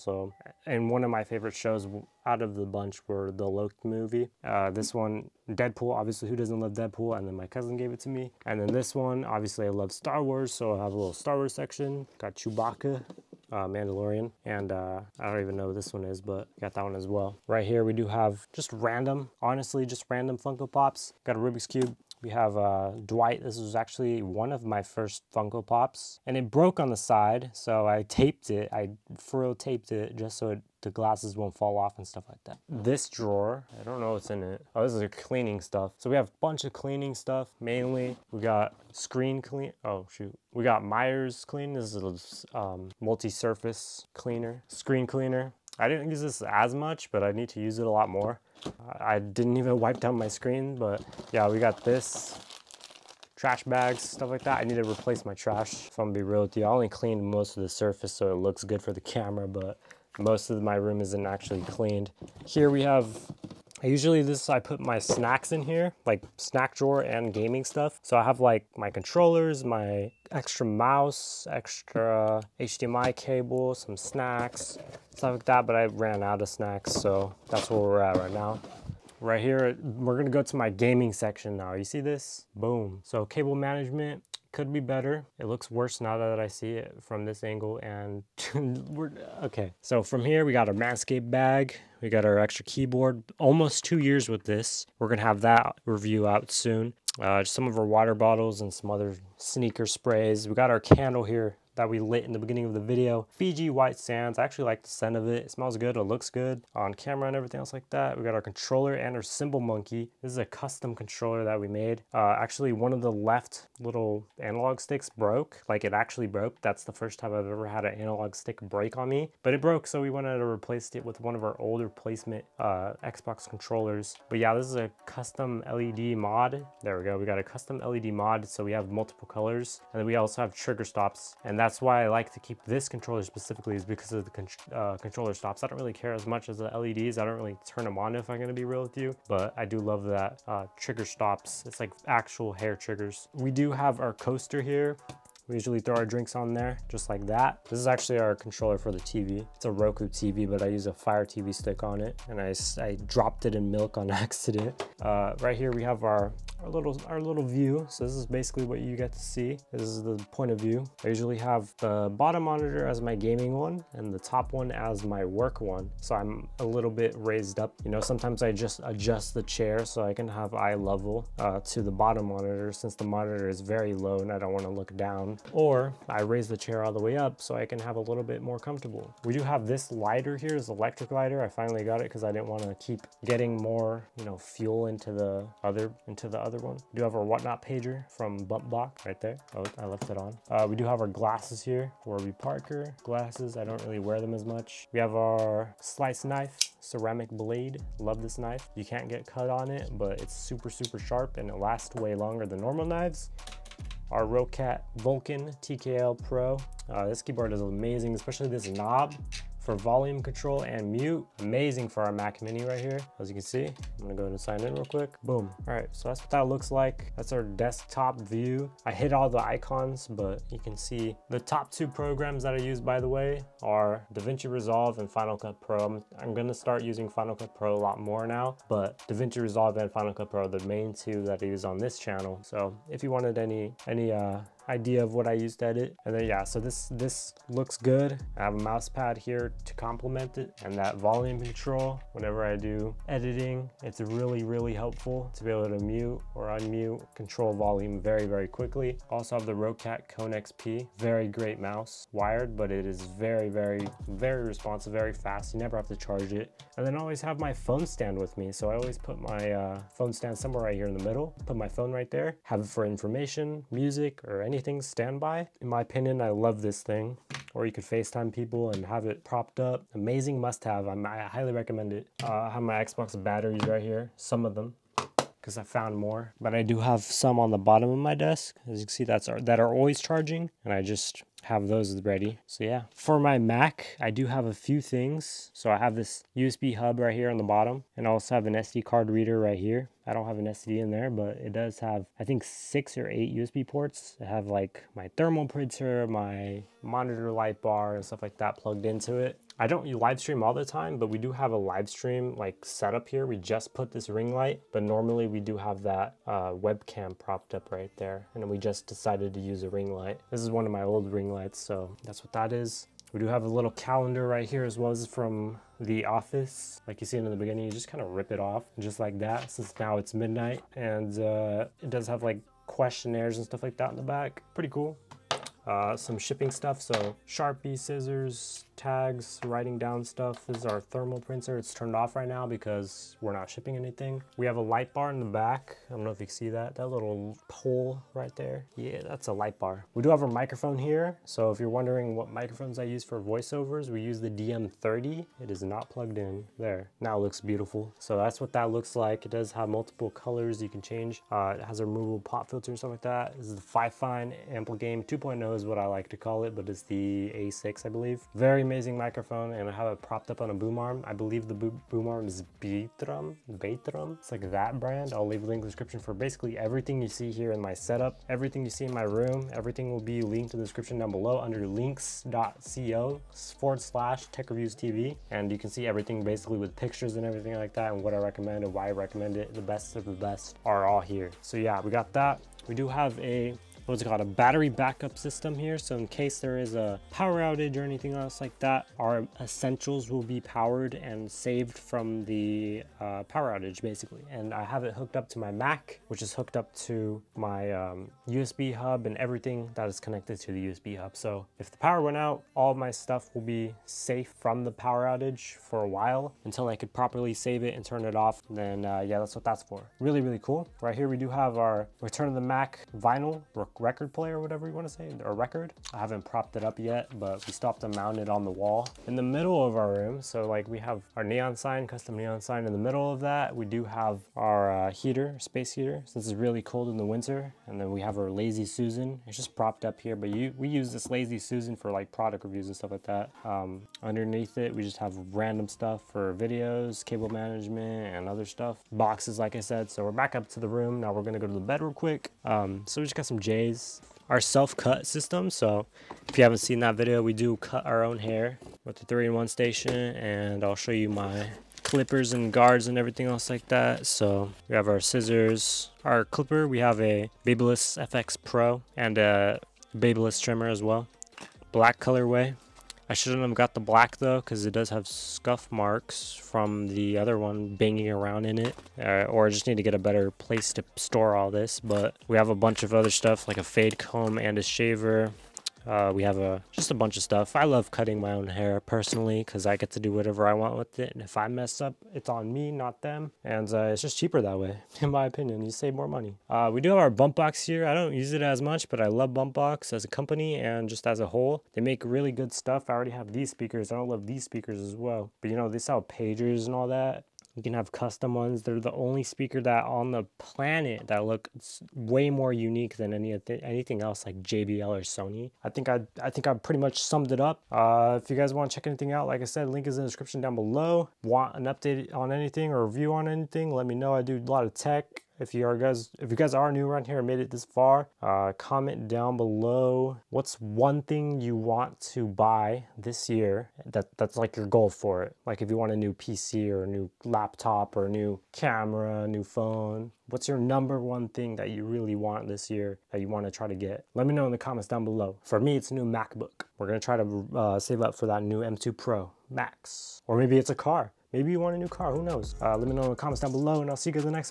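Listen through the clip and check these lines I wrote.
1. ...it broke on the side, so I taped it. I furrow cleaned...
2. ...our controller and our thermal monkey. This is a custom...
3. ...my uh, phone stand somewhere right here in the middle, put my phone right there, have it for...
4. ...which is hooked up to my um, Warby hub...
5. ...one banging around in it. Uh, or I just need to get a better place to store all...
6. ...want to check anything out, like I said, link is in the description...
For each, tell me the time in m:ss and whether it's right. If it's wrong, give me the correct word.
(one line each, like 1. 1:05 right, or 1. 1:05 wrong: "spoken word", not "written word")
1. 0:26 wrong: "taped", not "cleaned"
2. 1:48 wrong: "cymbal", not "thermal"
3. 4:19 right
4. 6:36 wrong: "USB", not "Warby"
5. 7:47 right
6. 8:28 right.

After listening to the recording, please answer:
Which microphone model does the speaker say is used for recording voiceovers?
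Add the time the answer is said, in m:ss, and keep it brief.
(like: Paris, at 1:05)
DM30, at 5:44.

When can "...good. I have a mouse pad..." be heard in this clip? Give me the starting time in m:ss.
3:57.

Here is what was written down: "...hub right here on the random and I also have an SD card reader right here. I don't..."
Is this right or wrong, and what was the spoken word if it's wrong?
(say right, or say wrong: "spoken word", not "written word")
wrong: "bottom", not "random".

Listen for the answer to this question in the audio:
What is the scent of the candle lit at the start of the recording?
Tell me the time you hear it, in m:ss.
1:43.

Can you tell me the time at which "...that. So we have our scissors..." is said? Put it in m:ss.
7:33.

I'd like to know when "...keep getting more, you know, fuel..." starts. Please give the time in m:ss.
3:02.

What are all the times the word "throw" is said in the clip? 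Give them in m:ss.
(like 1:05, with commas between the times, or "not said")
2:25.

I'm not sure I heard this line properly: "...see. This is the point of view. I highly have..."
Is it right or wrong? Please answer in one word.
wrong.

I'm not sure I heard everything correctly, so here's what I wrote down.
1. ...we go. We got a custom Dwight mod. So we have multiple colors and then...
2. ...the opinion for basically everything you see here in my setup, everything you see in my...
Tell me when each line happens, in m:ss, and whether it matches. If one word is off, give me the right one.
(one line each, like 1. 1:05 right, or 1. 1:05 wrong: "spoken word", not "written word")
1. 2:06 wrong: "LED", not "Dwight"
2. 6:05 wrong: "description", not "opinion".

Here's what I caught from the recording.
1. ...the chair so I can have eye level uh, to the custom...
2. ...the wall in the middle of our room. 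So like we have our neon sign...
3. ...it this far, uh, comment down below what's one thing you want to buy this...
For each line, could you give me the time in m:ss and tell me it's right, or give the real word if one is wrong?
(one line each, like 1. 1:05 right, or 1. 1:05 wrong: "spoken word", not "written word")
1. 2:49 wrong: "bottom", not "custom"
2. 6:58 right
3. 8:37 right.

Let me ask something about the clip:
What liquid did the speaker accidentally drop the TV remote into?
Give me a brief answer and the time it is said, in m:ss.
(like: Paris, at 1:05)
Milk, at 2:33.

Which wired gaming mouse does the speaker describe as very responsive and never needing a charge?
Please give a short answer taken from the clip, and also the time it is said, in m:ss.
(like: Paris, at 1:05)
Roccat Kone XP, at 4:09.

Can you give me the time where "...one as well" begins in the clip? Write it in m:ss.
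0:16.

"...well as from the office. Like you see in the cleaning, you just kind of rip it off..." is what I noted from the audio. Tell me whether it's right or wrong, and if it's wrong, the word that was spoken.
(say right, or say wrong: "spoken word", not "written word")
wrong: "beginning", not "cleaning".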